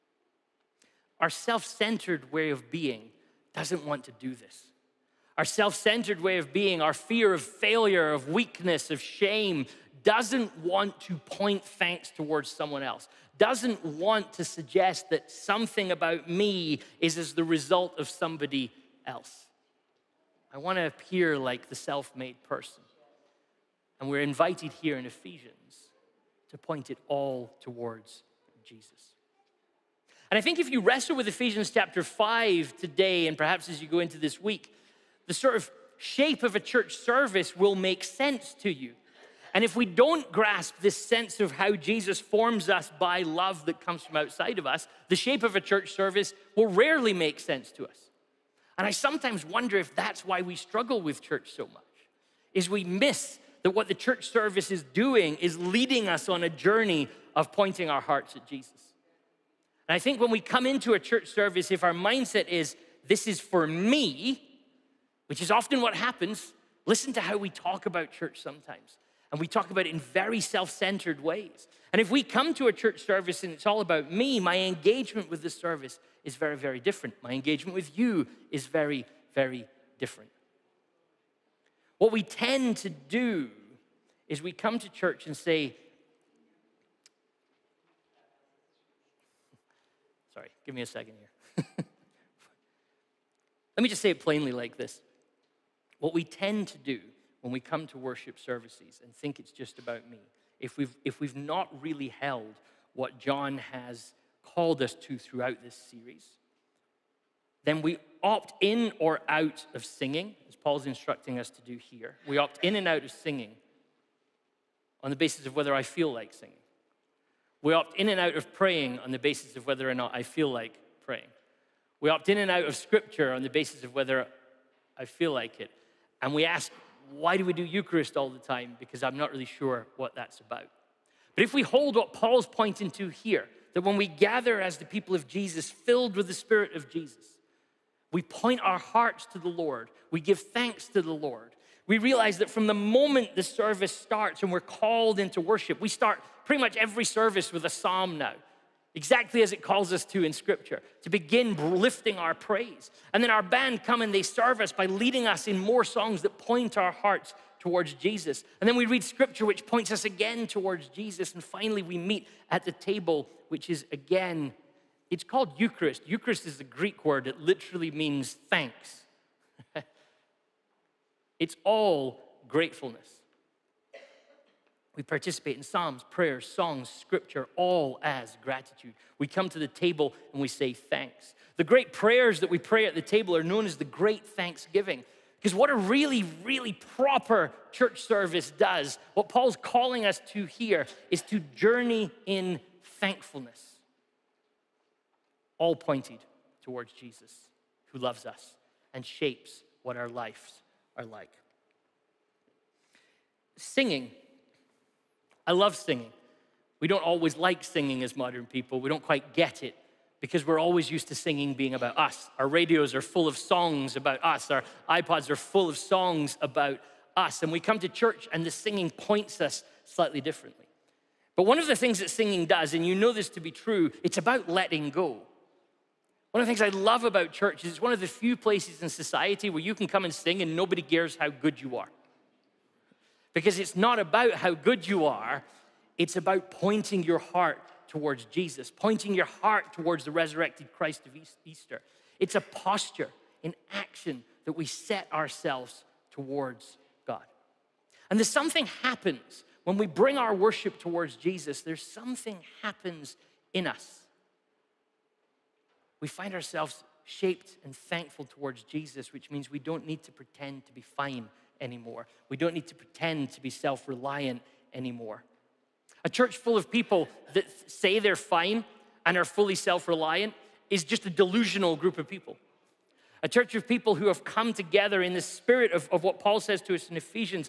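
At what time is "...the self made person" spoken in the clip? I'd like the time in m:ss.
0:21.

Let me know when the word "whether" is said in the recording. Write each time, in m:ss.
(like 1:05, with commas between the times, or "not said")
1:55, 1:59, 2:03.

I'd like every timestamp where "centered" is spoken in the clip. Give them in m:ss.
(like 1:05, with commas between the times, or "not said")
0:01, 0:05, 1:10.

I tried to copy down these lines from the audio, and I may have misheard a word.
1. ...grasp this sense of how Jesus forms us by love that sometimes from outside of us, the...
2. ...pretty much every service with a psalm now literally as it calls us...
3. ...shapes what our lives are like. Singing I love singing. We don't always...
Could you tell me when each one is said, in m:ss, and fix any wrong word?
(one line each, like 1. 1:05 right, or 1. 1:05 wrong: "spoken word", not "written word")
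1. 0:40 wrong: "comes", not "sometimes"
2. 2:26 wrong: "exactly", not "literally"
3. 3:19 right.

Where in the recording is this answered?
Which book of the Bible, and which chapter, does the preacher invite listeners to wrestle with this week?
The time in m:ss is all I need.
0:31.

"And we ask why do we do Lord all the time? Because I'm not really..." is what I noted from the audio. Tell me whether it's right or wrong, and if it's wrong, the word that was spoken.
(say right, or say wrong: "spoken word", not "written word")
wrong: "Eucharist", not "Lord".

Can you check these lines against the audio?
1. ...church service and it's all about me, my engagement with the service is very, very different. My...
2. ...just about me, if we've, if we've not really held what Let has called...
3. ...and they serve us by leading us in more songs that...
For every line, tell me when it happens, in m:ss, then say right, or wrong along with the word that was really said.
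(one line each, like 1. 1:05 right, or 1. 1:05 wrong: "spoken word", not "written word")
1. 1:12 right
2. 1:39 wrong: "John", not "Let"
3. 2:34 right.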